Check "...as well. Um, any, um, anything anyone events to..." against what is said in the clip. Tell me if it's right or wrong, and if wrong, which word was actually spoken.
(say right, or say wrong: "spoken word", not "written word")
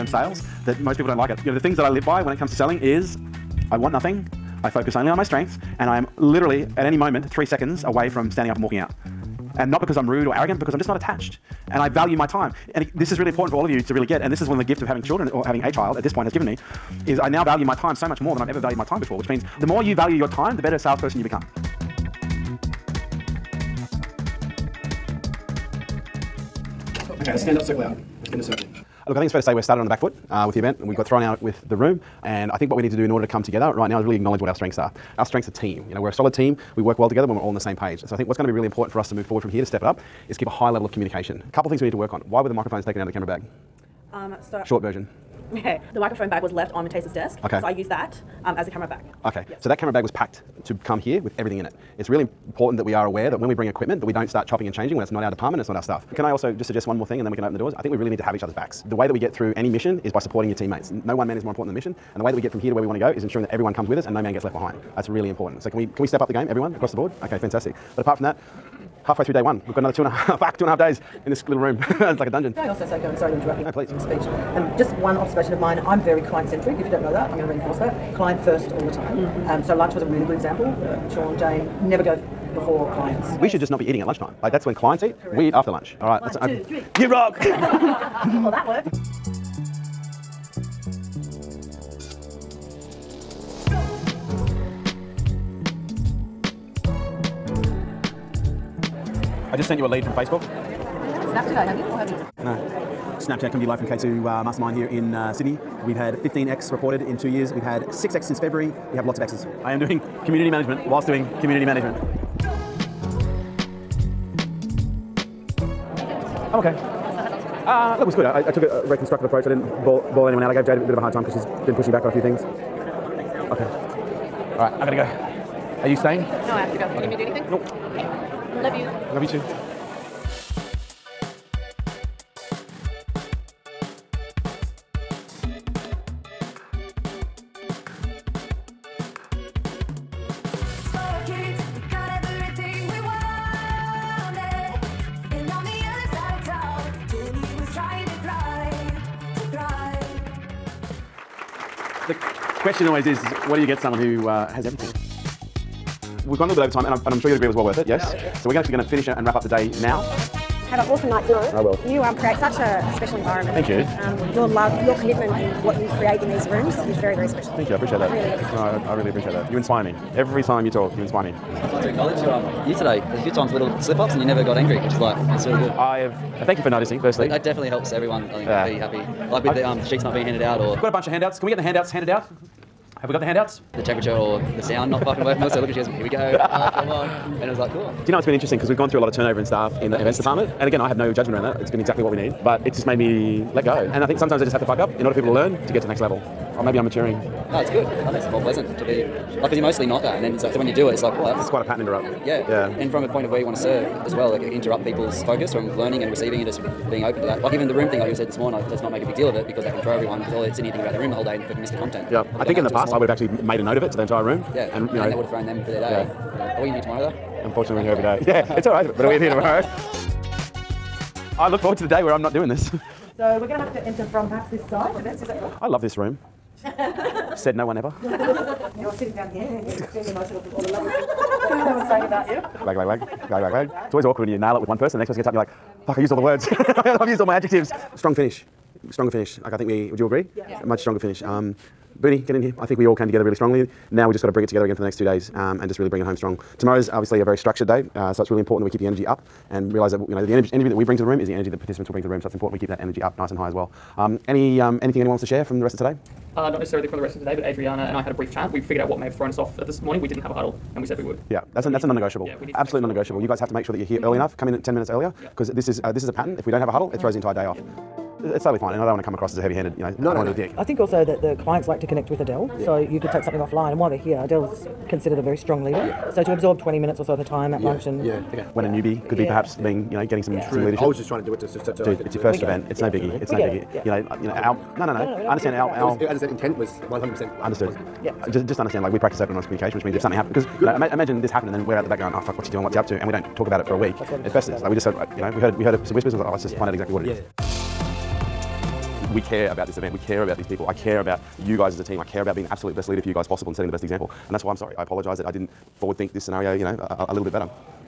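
wrong: "wants", not "events".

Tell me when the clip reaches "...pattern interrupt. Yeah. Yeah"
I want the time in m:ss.
3:21.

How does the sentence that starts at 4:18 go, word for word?
We figured out what may have thrown us off at this morning.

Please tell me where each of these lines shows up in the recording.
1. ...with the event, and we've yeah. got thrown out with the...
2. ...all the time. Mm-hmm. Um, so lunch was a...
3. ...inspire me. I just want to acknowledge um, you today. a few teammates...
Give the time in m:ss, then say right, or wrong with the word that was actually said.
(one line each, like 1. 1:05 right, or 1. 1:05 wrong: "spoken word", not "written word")
1. 0:30 right
2. 1:18 right
3. 2:51 wrong: "times", not "teammates".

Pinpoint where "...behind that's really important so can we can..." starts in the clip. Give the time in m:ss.
1:04.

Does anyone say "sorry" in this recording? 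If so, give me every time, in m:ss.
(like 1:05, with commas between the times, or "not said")
1:13, 5:04.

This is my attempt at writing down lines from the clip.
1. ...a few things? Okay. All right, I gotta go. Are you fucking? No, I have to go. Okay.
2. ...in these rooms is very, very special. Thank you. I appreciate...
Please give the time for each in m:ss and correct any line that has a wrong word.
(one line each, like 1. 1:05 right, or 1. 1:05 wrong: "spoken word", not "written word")
1. 2:02 wrong: "staying", not "fucking"
2. 2:46 right.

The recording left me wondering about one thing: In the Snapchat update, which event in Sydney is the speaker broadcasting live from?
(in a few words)
K2 Mastermind.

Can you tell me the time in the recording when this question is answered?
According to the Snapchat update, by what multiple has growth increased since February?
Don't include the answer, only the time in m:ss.
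1:47.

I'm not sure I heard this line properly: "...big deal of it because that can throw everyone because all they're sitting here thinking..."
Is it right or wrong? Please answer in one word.
right.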